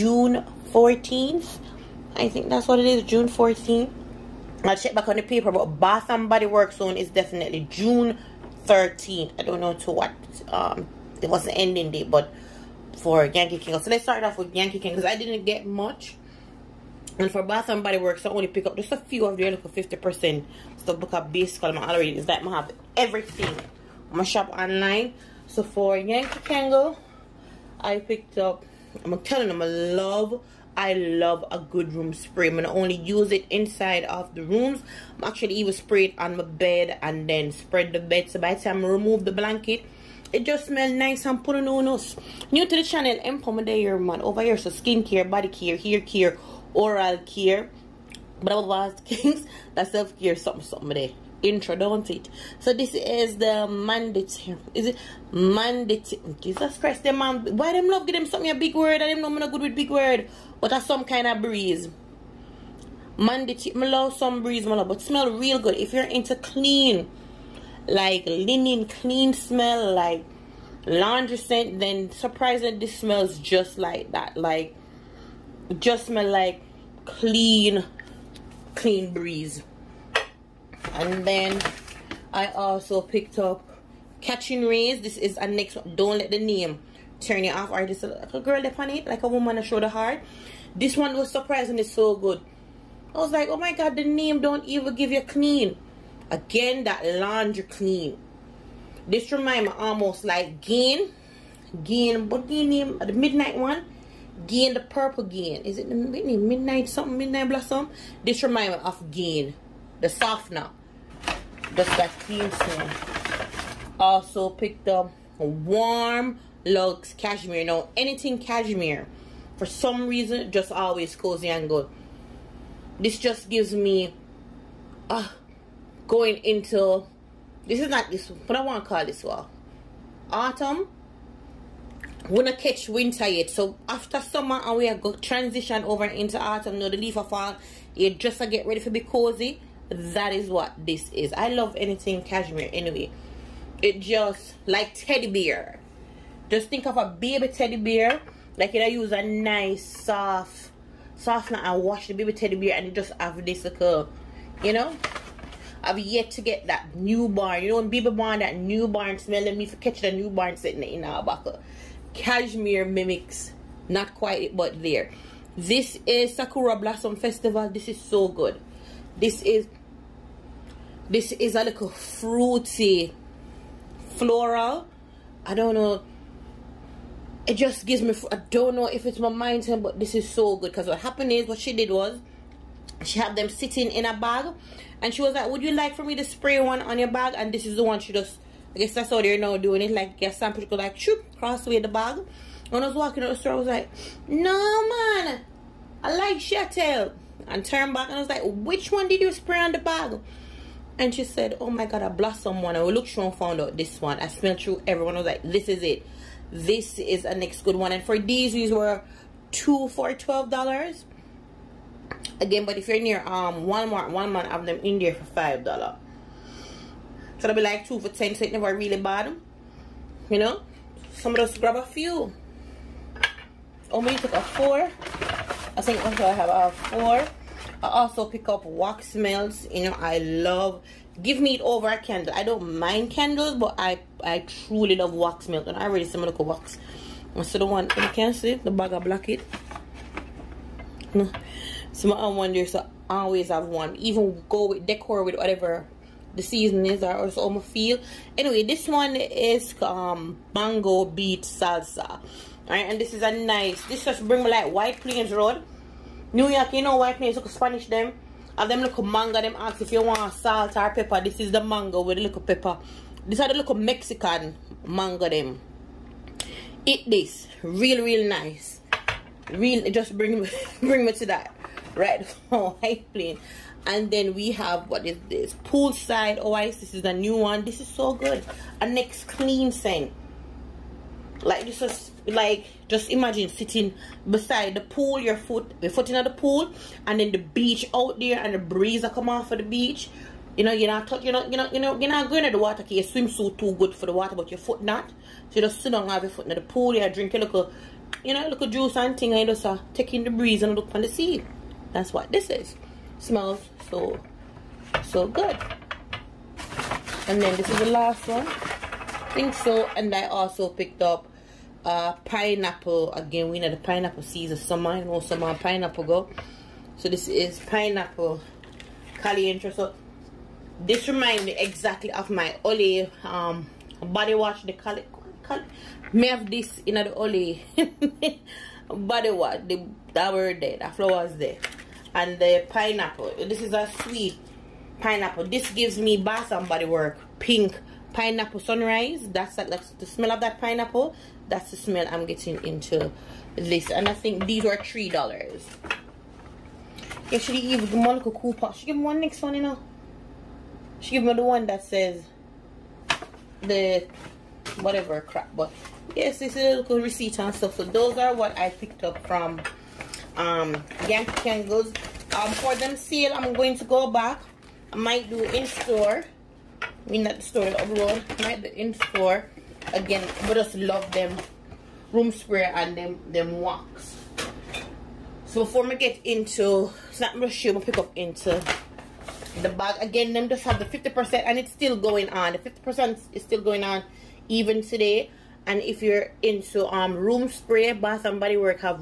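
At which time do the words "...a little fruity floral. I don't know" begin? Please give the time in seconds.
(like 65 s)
171 s.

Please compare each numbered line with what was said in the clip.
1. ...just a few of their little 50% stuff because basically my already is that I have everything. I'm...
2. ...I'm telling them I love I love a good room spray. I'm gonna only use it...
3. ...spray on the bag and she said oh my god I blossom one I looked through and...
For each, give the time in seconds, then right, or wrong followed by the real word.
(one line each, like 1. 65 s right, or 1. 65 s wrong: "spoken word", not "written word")
1. 18 s right
2. 29 s right
3. 199 s right.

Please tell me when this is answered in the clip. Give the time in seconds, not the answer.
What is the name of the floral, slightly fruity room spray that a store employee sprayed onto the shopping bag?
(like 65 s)
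166 s.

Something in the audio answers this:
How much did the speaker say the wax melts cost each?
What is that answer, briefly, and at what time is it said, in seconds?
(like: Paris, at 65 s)
$3, at 344 s.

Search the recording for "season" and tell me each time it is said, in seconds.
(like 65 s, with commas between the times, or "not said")
246 s, 314 s.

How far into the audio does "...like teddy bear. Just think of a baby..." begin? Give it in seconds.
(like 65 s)
144 s.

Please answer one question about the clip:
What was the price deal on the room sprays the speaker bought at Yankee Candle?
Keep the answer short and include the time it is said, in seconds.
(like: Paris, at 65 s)
2 for $12, at 209 s.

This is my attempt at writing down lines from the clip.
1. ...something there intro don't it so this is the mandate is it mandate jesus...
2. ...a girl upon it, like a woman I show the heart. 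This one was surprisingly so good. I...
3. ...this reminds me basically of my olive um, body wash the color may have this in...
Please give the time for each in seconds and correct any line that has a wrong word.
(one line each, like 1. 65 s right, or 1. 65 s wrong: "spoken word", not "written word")
1. 50 s right
2. 88 s right
3. 320 s wrong: "exactly", not "basically".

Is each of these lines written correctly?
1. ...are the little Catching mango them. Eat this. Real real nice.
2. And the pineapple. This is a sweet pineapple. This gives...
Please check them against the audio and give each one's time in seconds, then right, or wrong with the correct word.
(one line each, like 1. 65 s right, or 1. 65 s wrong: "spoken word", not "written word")
1. 263 s wrong: "Mexican", not "Catching"
2. 332 s right.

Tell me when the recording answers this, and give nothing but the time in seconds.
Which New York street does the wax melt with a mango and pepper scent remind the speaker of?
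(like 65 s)
254 s.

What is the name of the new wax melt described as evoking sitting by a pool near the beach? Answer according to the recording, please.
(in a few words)
Poolside Oasis.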